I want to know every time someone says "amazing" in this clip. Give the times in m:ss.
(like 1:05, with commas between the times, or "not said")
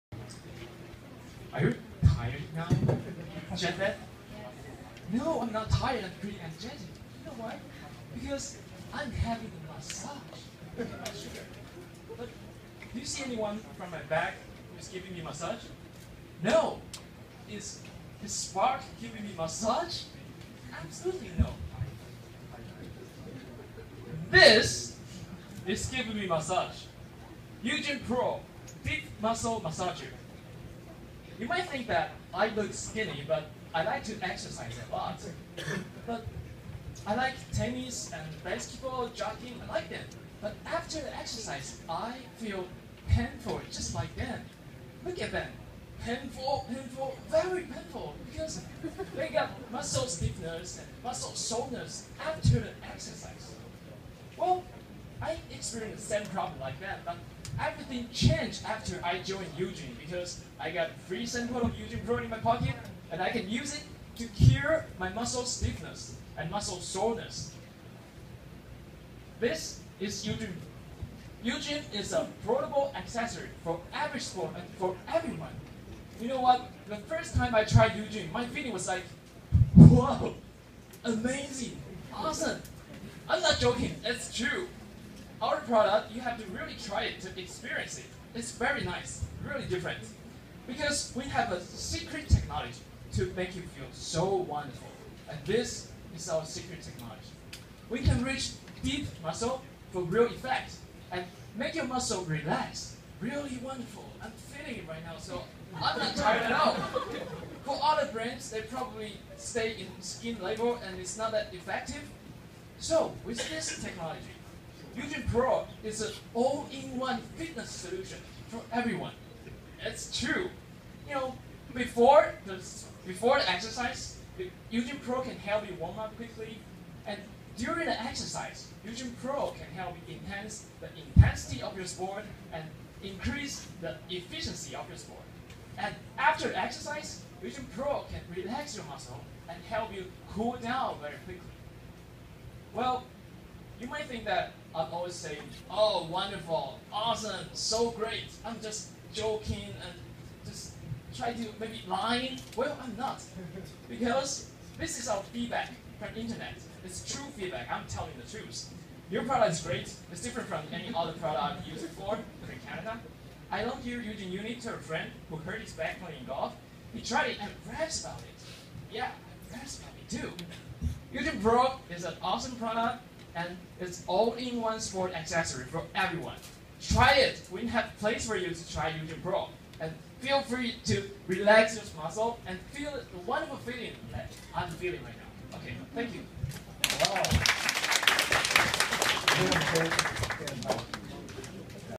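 1:21.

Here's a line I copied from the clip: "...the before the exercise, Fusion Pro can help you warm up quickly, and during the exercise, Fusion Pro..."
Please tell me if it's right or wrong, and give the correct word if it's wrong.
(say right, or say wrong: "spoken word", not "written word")
right.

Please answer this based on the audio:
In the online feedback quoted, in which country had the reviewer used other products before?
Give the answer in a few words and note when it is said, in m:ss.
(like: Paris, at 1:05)
Canada, at 2:42.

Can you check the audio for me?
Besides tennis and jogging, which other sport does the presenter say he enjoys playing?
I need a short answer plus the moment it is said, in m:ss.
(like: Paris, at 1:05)
Basketball, at 0:38.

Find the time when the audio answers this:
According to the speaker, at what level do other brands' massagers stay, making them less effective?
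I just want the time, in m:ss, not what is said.
1:50.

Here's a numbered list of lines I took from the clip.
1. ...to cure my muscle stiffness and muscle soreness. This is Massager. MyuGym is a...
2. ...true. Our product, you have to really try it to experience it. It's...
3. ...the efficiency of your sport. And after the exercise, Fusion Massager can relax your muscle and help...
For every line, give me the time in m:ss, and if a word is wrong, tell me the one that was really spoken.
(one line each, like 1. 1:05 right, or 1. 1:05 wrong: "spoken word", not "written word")
1. 1:04 wrong: "MyuGym", not "Massager"
2. 1:24 right
3. 2:13 wrong: "Pro", not "Massager".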